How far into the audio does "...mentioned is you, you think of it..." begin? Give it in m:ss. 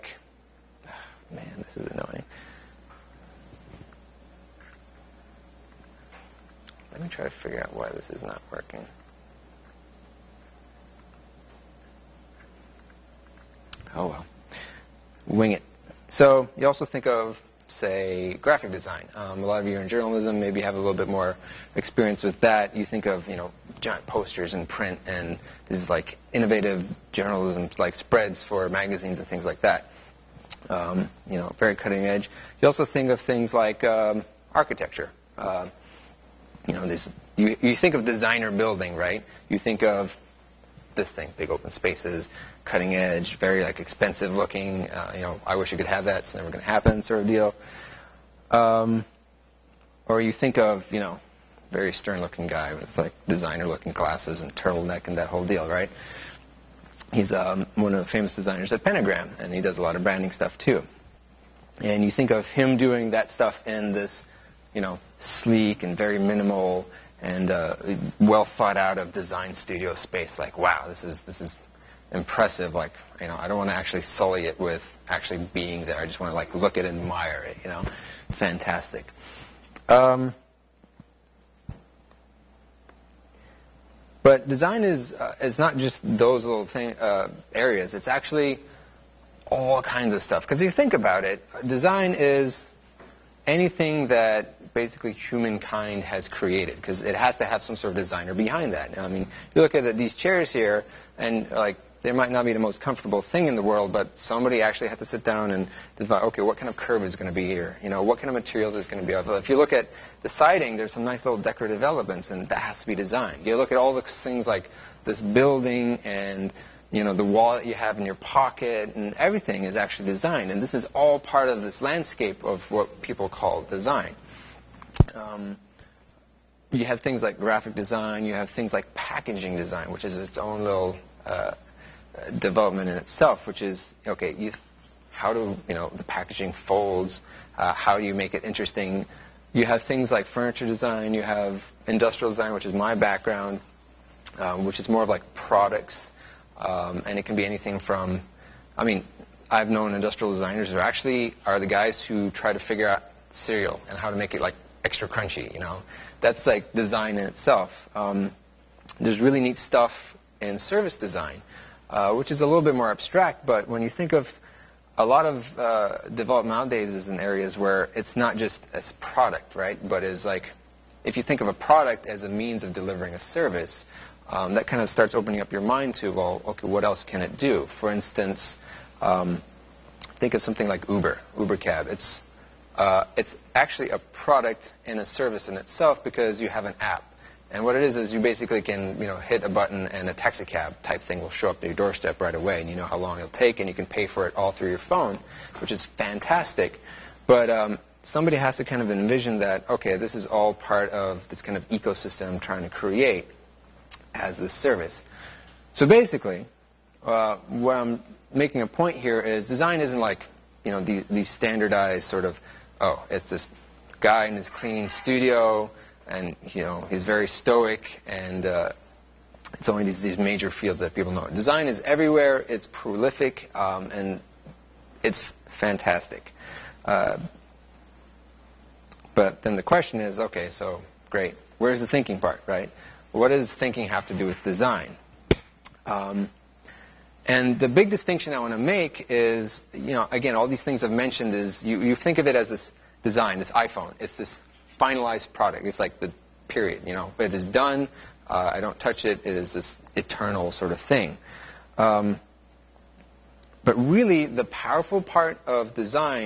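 4:00.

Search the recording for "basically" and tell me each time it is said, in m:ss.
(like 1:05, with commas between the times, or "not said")
1:34, 3:08, 3:25.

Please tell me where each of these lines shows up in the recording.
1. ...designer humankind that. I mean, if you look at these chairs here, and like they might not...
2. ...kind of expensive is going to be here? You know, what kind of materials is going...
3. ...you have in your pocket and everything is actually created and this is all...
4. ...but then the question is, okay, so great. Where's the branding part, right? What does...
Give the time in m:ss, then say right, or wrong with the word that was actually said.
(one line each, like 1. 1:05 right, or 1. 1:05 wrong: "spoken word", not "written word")
1. 1:37 wrong: "behind", not "humankind"
2. 1:46 wrong: "curve", not "expensive"
3. 1:57 wrong: "designed", not "created"
4. 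3:49 wrong: "thinking", not "branding".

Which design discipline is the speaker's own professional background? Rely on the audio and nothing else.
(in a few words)
Industrial design.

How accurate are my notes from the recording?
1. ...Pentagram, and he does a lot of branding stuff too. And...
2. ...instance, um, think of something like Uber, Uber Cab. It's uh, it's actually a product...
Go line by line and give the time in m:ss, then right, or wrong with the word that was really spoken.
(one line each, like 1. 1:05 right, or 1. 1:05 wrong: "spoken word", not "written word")
1. 0:58 right
2. 2:57 right.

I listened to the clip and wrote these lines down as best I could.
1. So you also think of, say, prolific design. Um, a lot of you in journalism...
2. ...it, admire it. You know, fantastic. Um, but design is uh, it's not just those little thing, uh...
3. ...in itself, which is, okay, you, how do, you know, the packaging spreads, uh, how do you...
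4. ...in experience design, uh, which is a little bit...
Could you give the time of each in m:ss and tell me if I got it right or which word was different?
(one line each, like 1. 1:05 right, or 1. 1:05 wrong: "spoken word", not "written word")
1. 0:16 wrong: "graphic", not "prolific"
2. 1:16 right
3. 2:12 wrong: "folds", not "spreads"
4. 2:40 wrong: "service", not "experience".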